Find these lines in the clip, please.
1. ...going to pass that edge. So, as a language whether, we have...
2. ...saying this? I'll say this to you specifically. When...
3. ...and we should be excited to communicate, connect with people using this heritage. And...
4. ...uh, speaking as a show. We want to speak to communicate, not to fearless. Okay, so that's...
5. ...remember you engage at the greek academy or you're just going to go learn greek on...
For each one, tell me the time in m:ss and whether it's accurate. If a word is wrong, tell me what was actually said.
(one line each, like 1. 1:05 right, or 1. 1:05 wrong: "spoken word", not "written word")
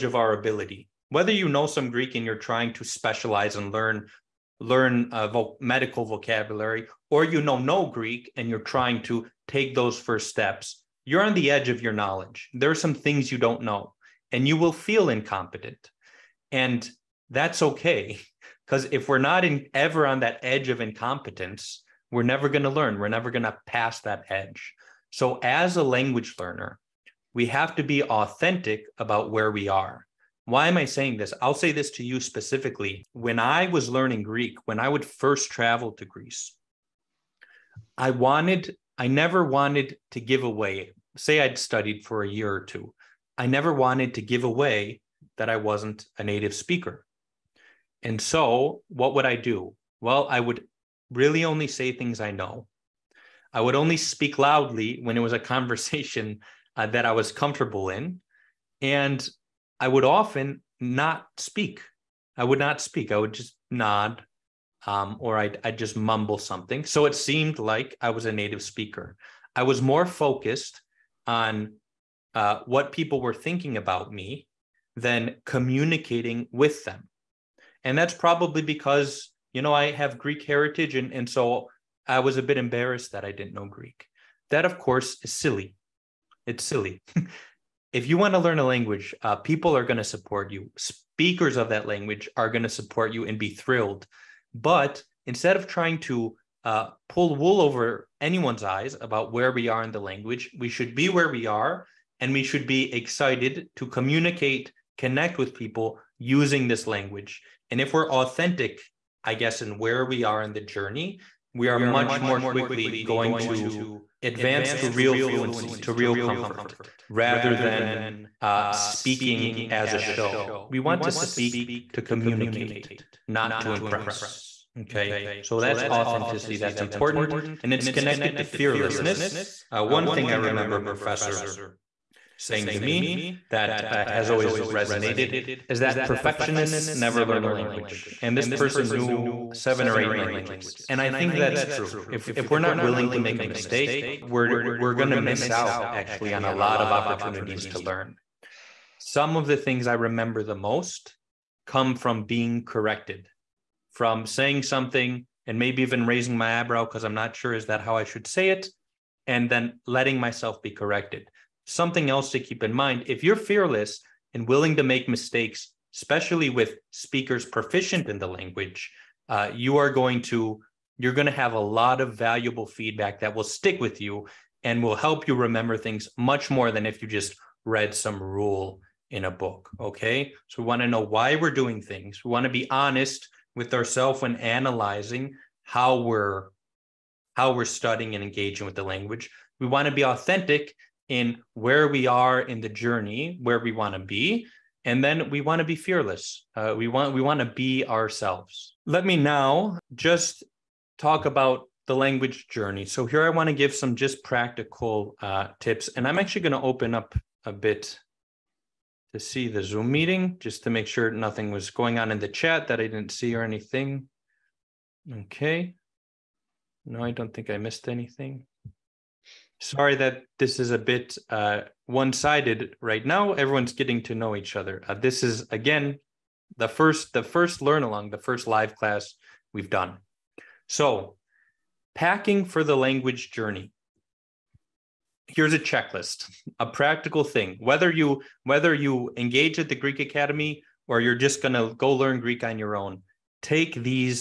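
1. 0:23 wrong: "learner", not "whether"
2. 0:30 right
3. 1:42 wrong: "language", not "heritage"
4. 1:58 wrong: "impress", not "fearless"
5. 3:58 wrong: "whether", not "remember".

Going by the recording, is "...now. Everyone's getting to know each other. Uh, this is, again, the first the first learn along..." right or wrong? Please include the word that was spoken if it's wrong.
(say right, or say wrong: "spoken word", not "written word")
right.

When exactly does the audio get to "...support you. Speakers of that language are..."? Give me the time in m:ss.
1:30.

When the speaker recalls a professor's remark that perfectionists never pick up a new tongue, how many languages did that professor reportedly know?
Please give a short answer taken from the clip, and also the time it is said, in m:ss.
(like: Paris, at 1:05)
7 or 8, at 2:19.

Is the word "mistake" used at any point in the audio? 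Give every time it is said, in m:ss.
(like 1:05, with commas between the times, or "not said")
2:23, 2:45.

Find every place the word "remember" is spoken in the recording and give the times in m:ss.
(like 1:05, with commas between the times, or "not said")
2:10, 2:30, 2:55.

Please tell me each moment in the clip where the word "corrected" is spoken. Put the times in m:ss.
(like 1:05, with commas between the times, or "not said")
2:32, 2:40.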